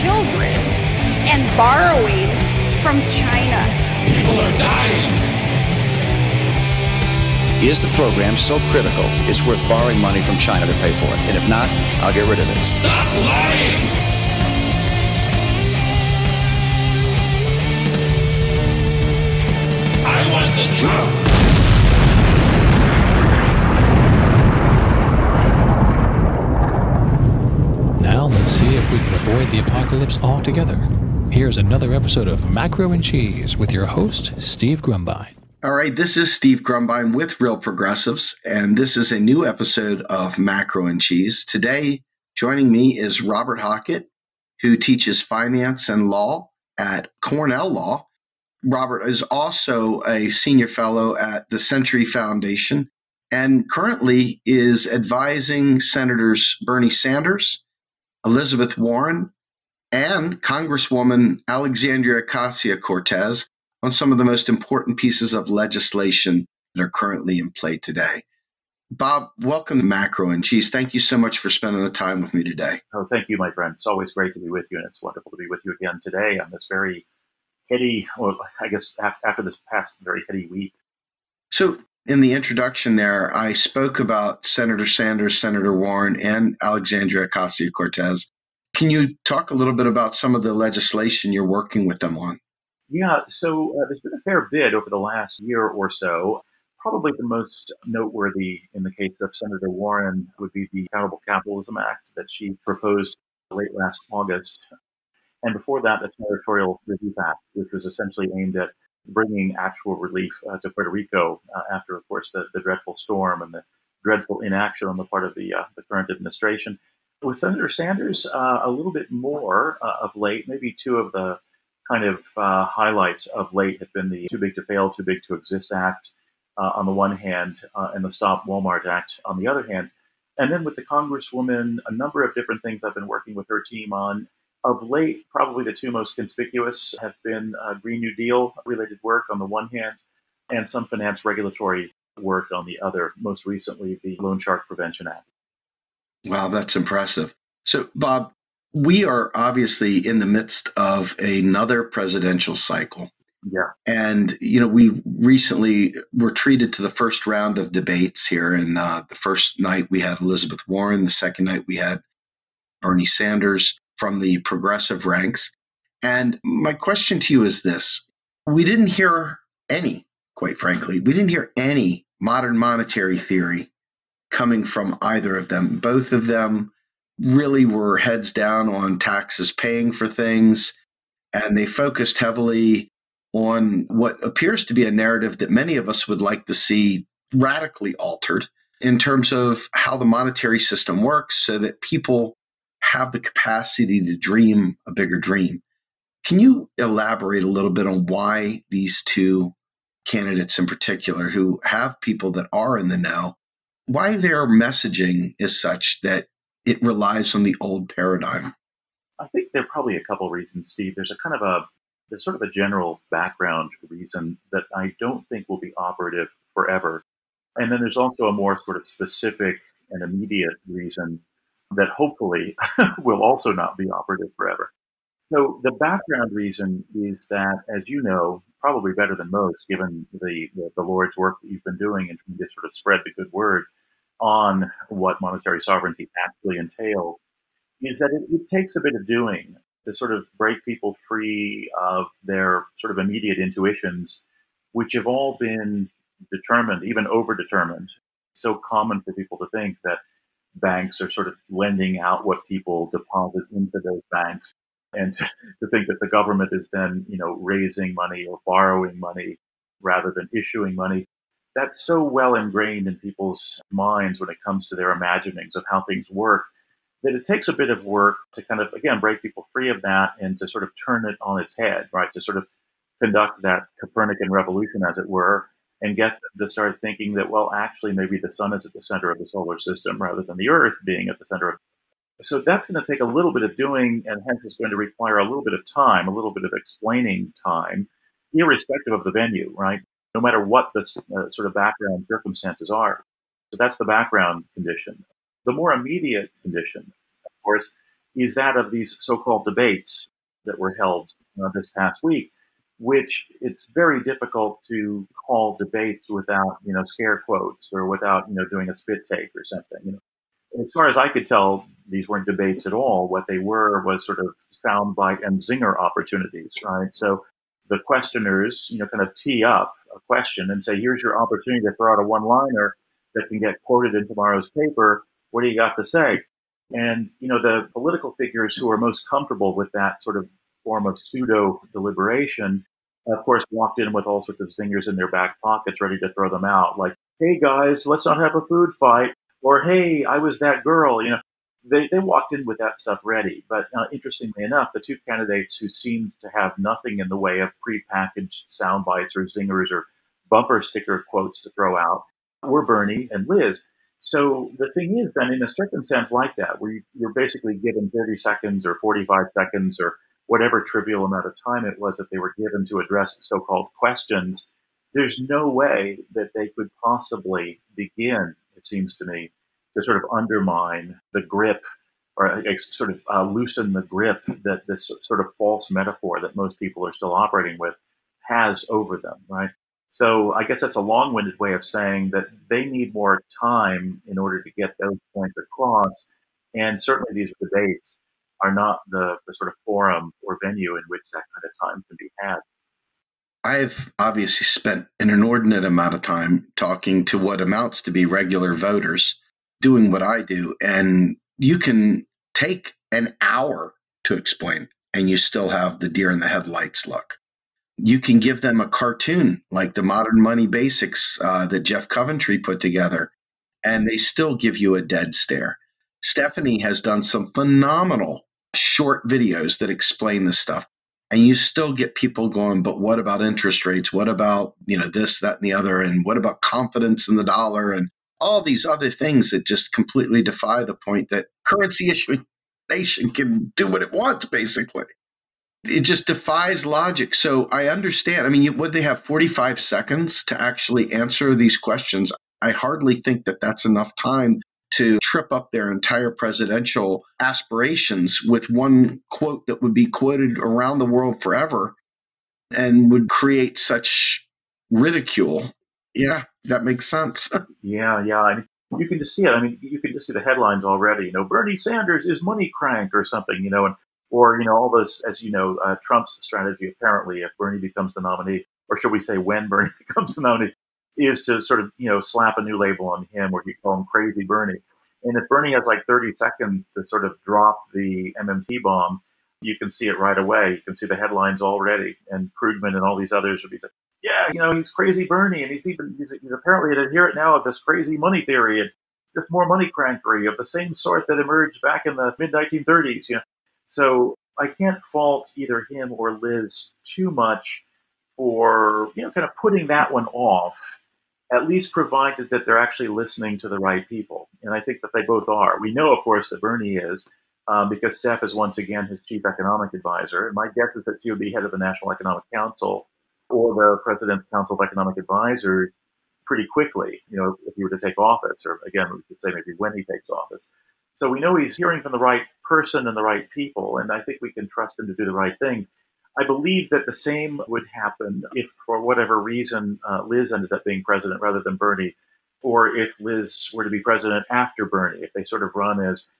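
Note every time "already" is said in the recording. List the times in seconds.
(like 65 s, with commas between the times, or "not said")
460 s, 481 s.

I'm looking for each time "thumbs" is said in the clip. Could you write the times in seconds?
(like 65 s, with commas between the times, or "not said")
not said.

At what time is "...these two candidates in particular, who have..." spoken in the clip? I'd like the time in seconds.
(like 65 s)
198 s.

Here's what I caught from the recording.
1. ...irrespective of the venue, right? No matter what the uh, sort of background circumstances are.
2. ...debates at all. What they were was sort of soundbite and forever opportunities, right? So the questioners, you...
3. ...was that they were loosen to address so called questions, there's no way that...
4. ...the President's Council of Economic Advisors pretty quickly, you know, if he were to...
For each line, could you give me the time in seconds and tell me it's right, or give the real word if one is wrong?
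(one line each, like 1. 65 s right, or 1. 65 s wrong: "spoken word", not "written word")
1. 288 s right
2. 312 s wrong: "zinger", not "forever"
3. 361 s wrong: "given", not "loosen"
4. 513 s right.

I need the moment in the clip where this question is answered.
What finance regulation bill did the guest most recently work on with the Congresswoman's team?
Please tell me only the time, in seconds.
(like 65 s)
144 s.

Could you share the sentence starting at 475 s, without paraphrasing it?
And if Bernie has like 30 seconds to sort of drop the MMT bomb, you can see it right away.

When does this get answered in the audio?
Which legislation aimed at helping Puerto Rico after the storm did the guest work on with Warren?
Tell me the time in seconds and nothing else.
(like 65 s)
106 s.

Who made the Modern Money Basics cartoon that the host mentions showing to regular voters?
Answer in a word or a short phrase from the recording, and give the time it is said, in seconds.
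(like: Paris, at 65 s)
Jeff Coventry, at 411 s.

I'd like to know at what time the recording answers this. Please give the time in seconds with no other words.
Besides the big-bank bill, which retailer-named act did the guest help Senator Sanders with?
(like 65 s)
128 s.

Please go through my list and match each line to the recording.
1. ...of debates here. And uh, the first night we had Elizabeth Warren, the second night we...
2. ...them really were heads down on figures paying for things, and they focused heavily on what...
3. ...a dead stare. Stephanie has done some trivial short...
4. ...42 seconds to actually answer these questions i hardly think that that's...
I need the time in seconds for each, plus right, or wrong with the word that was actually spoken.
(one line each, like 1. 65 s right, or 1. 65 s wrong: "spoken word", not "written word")
1. 157 s right
2. 176 s wrong: "taxes", not "figures"
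3. 414 s wrong: "phenomenal", not "trivial"
4. 438 s wrong: "45", not "42".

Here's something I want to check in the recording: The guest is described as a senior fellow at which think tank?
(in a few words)
Century Foundation.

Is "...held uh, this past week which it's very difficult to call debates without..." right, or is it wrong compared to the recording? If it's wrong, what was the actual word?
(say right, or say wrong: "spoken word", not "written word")
right.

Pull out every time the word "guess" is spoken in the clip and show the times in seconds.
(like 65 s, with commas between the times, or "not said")
78 s, 380 s, 510 s.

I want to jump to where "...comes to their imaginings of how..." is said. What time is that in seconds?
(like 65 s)
264 s.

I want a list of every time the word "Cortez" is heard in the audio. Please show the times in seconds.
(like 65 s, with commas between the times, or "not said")
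62 s, 87 s.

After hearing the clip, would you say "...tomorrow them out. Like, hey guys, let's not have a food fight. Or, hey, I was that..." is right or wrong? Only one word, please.
wrong.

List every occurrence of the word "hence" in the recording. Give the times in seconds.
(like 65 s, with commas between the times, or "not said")
284 s.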